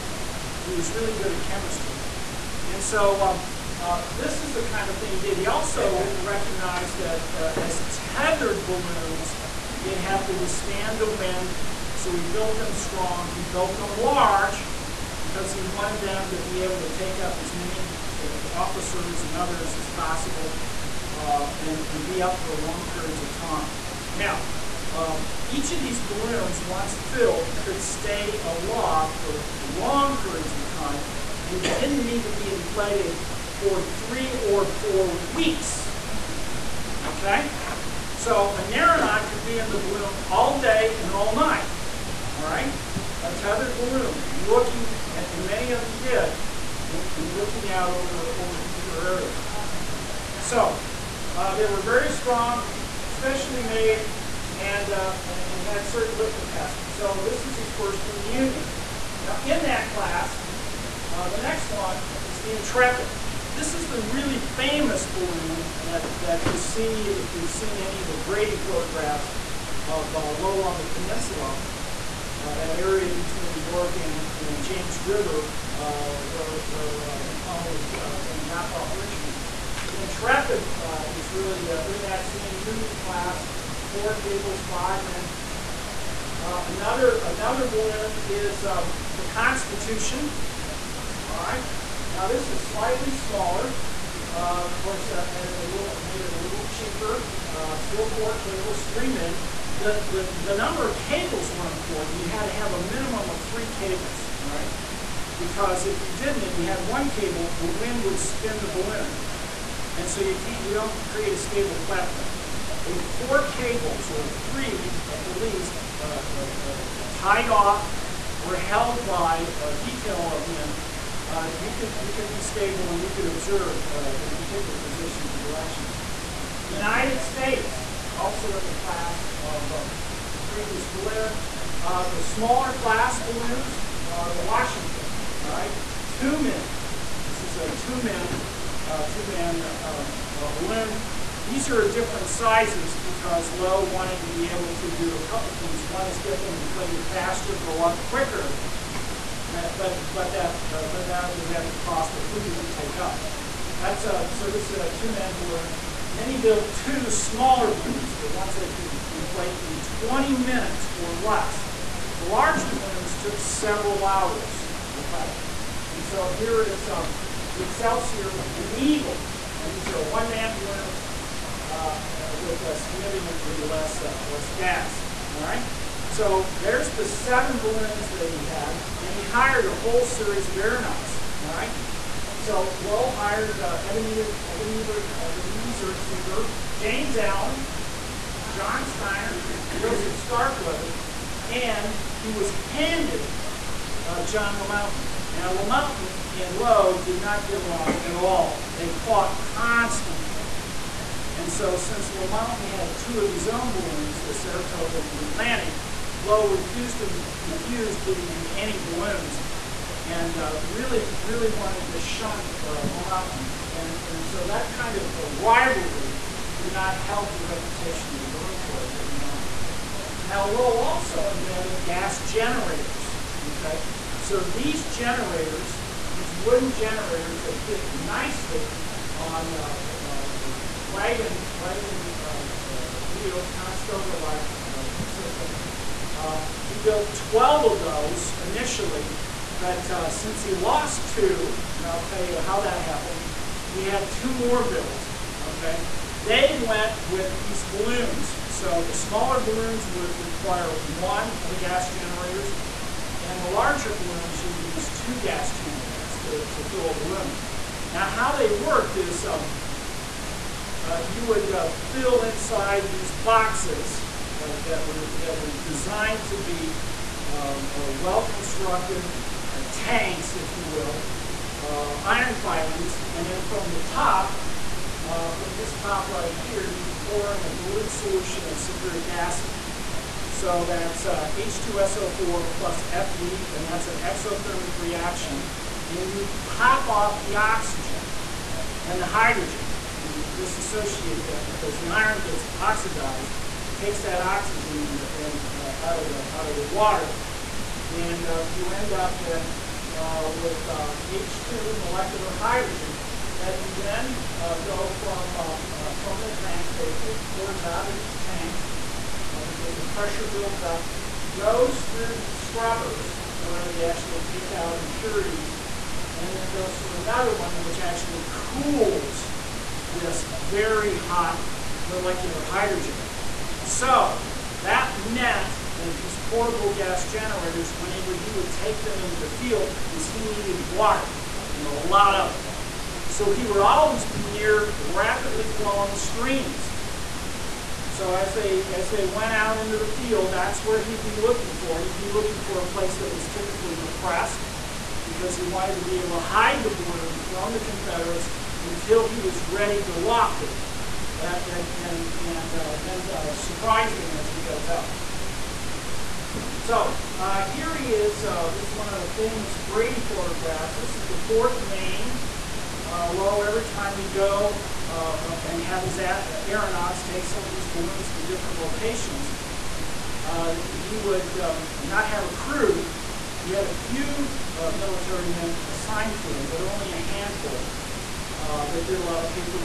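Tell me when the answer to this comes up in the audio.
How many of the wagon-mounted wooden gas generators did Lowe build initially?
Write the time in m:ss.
3:57.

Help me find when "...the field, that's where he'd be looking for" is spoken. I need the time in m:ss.
5:39.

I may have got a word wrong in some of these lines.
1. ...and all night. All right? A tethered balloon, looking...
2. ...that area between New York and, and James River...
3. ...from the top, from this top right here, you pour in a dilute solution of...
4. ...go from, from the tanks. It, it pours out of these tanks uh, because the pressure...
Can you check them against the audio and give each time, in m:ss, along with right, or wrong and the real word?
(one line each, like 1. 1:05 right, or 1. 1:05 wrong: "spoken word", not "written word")
1. 0:41 right
2. 1:12 right
3. 4:33 right
4. 5:04 right.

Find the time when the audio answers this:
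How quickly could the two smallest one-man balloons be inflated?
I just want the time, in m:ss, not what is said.
2:39.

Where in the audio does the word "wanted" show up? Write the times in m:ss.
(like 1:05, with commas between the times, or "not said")
0:15, 2:23, 3:31, 5:45.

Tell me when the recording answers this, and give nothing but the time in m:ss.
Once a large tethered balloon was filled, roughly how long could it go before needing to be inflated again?
0:33.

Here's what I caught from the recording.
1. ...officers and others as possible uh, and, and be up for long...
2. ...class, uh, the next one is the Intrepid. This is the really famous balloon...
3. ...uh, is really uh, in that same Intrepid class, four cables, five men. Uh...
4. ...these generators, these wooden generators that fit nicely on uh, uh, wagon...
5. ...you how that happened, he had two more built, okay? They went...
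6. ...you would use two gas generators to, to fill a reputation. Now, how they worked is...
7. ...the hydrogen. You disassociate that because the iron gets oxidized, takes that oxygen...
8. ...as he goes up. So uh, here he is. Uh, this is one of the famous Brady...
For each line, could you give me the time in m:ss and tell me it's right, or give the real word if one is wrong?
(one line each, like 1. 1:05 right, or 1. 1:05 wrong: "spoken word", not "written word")
1. 0:18 right
2. 0:59 right
3. 1:20 wrong: "Union", not "Intrepid"
4. 3:44 right
5. 4:02 right
6. 4:14 wrong: "balloon", not "reputation"
7. 4:49 right
8. 5:54 right.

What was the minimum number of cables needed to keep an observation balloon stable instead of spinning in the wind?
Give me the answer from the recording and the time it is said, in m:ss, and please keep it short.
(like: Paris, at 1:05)
3, at 1:43.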